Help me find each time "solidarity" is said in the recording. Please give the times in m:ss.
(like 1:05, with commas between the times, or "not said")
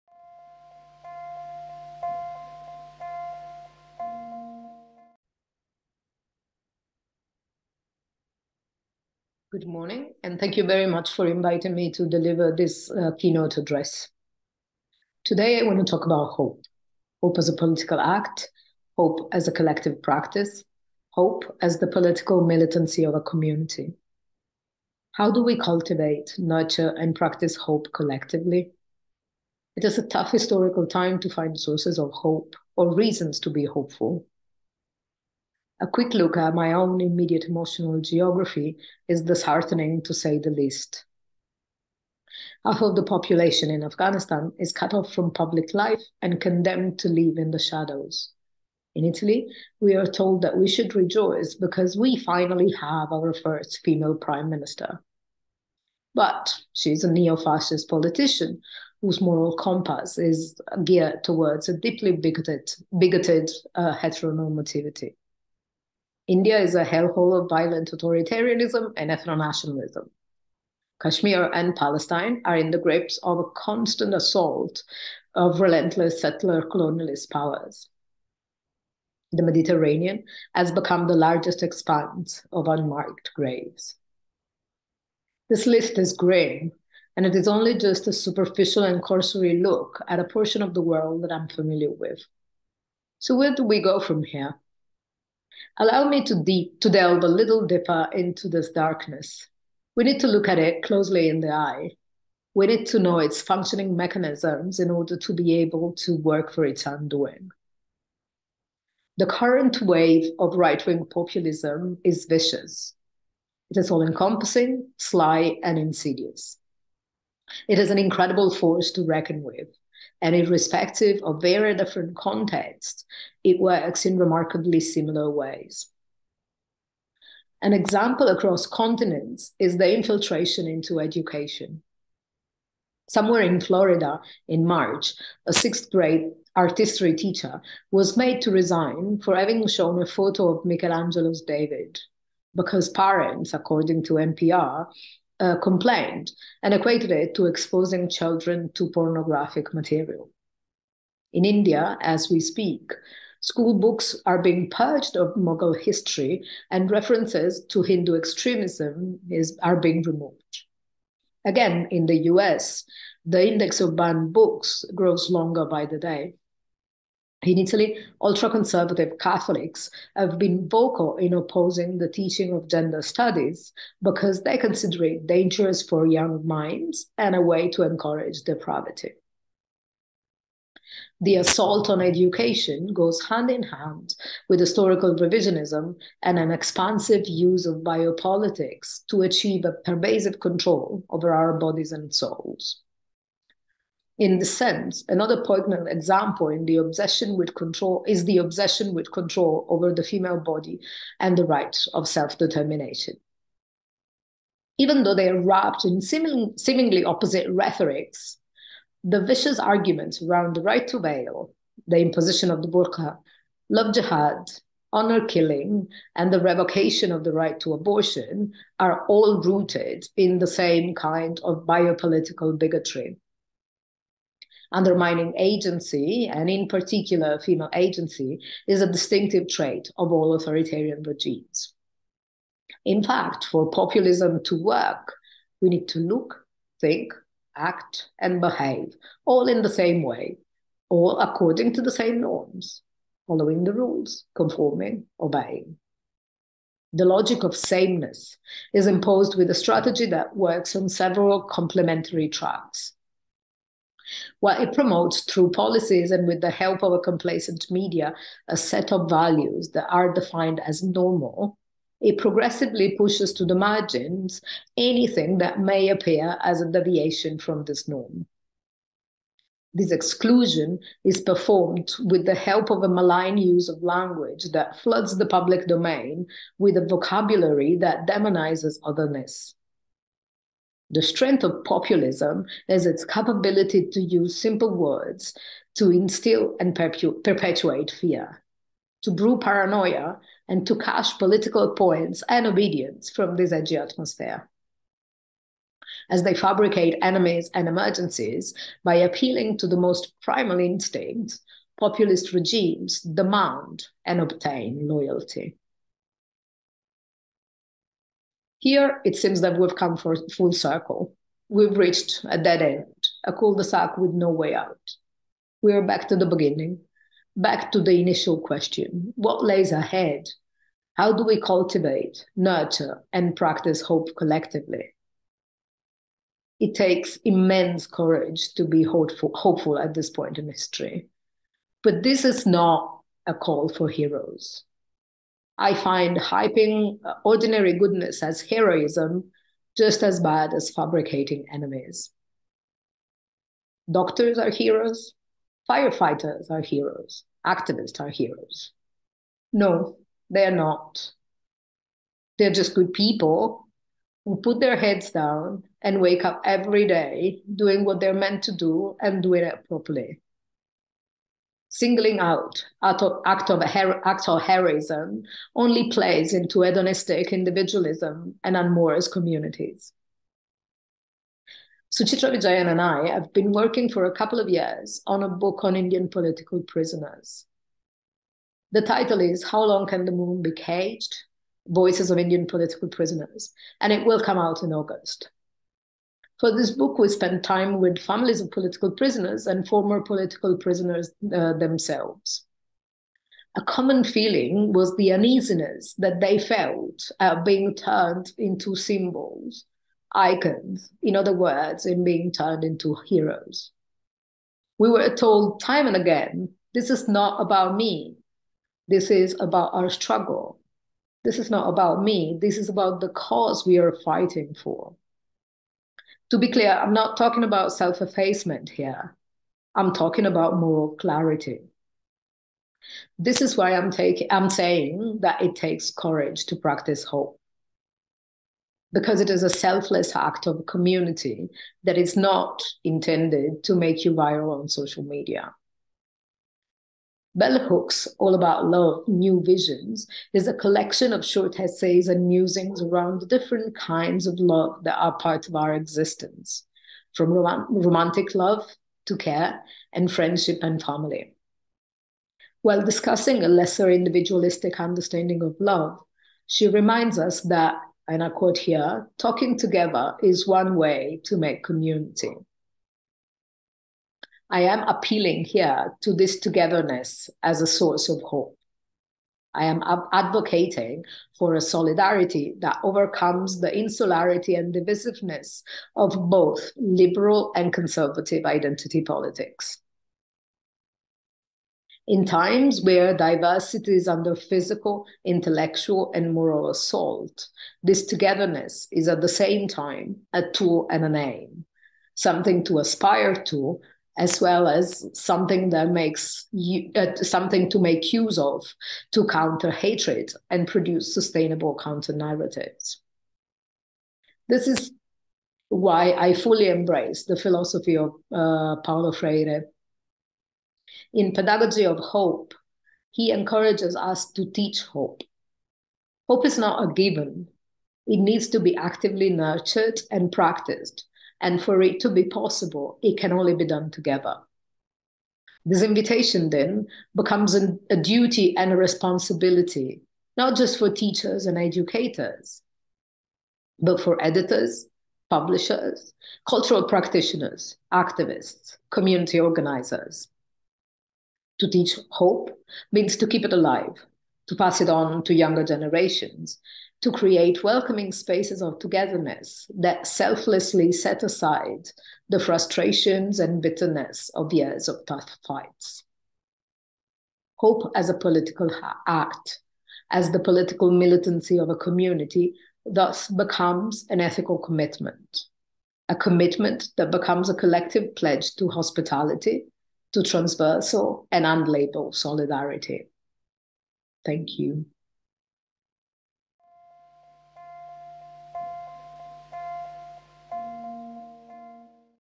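7:51, 9:32.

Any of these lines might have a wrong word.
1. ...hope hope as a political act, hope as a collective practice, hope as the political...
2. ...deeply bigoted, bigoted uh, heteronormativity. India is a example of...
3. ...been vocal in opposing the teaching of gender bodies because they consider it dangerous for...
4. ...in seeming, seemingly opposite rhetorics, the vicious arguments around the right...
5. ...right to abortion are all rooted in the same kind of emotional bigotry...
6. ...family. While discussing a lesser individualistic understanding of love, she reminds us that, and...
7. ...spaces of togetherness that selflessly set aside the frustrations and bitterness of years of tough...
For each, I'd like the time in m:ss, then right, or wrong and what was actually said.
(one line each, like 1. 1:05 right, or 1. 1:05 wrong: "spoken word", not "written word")
1. 0:16 right
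2. 1:01 wrong: "hellhole", not "example"
3. 2:50 wrong: "studies", not "bodies"
4. 3:25 right
5. 3:37 wrong: "biopolitical", not "emotional"
6. 7:30 right
7. 9:08 right.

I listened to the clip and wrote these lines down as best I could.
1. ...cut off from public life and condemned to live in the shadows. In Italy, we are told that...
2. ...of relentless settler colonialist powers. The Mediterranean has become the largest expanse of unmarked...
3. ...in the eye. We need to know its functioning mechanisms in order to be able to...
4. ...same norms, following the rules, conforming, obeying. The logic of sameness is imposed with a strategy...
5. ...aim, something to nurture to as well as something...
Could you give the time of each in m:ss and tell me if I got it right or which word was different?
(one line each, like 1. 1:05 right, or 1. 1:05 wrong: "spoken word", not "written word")
1. 0:44 right
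2. 1:15 right
3. 1:41 right
4. 4:01 right
5. 8:11 wrong: "aspire", not "nurture".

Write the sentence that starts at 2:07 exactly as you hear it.
An example across continents is the infiltration into education.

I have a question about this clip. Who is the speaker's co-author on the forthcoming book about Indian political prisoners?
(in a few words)
Suchitra Vijayan.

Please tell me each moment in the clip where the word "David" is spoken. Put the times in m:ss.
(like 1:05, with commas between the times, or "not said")
2:21.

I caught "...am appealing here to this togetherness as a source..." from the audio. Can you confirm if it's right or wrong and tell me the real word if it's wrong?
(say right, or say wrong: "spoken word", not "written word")
right.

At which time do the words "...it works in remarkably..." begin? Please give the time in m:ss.
2:03.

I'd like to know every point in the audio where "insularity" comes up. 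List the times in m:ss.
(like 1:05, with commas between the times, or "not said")
7:53.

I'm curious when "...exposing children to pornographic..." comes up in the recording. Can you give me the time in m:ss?
2:27.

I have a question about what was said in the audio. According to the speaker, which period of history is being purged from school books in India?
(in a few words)
Mughal history.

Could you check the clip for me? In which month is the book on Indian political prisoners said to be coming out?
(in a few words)
August.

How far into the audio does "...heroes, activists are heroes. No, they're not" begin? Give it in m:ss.
5:46.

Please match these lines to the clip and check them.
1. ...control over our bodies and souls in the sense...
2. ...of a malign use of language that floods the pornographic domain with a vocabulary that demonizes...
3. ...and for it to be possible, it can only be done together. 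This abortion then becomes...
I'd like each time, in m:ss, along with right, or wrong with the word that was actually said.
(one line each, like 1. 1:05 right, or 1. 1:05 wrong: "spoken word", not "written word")
1. 3:10 right
2. 4:32 wrong: "public", not "pornographic"
3. 8:41 wrong: "invitation", not "abortion".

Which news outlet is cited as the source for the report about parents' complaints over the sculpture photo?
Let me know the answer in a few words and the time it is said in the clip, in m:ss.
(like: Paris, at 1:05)
NPR, at 2:24.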